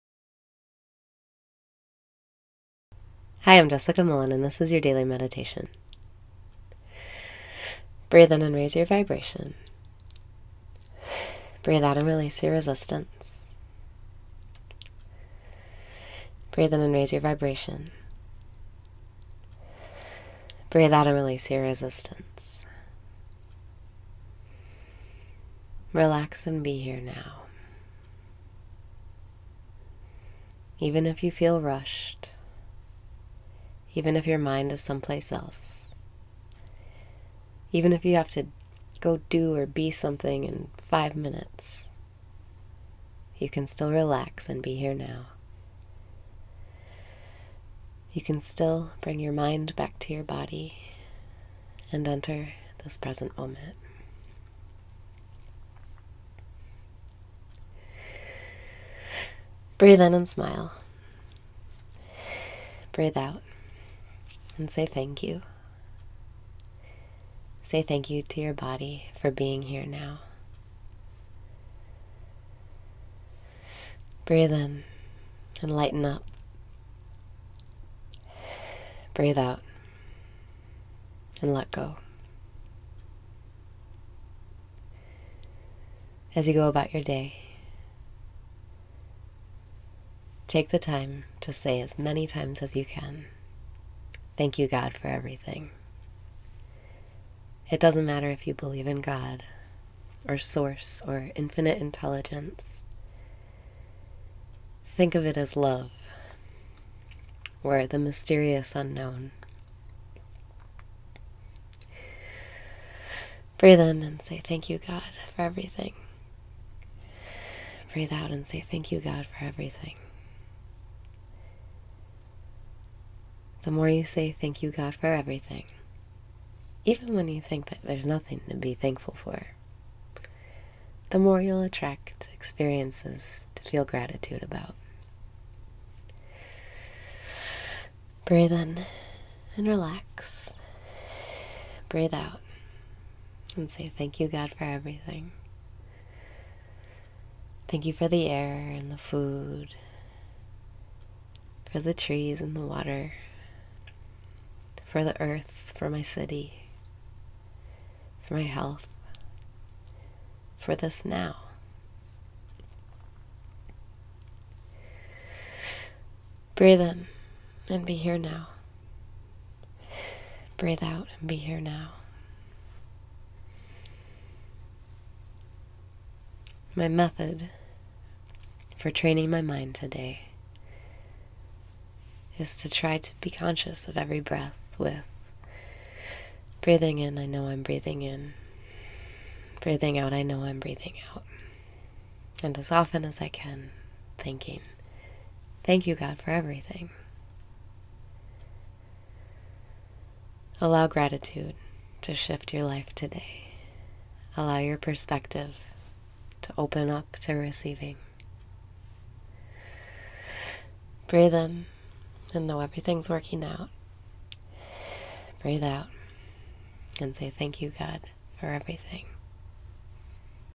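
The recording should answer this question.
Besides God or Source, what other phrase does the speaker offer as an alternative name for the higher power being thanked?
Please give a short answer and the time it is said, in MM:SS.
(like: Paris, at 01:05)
infinite intelligence, at 01:41.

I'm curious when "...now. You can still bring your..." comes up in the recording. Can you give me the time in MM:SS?
00:44.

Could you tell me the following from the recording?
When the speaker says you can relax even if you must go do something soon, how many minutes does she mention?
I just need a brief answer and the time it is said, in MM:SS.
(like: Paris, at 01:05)
5, at 00:40.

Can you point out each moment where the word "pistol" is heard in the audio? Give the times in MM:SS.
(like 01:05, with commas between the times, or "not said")
not said.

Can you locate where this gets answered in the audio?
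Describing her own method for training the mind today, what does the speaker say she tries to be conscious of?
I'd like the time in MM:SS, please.
03:03.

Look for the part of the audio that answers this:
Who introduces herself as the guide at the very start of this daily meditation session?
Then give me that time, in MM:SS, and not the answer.
00:03.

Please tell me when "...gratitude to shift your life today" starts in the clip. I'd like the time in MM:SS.
03:20.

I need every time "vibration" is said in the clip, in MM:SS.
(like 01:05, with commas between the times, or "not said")
00:08, 00:17.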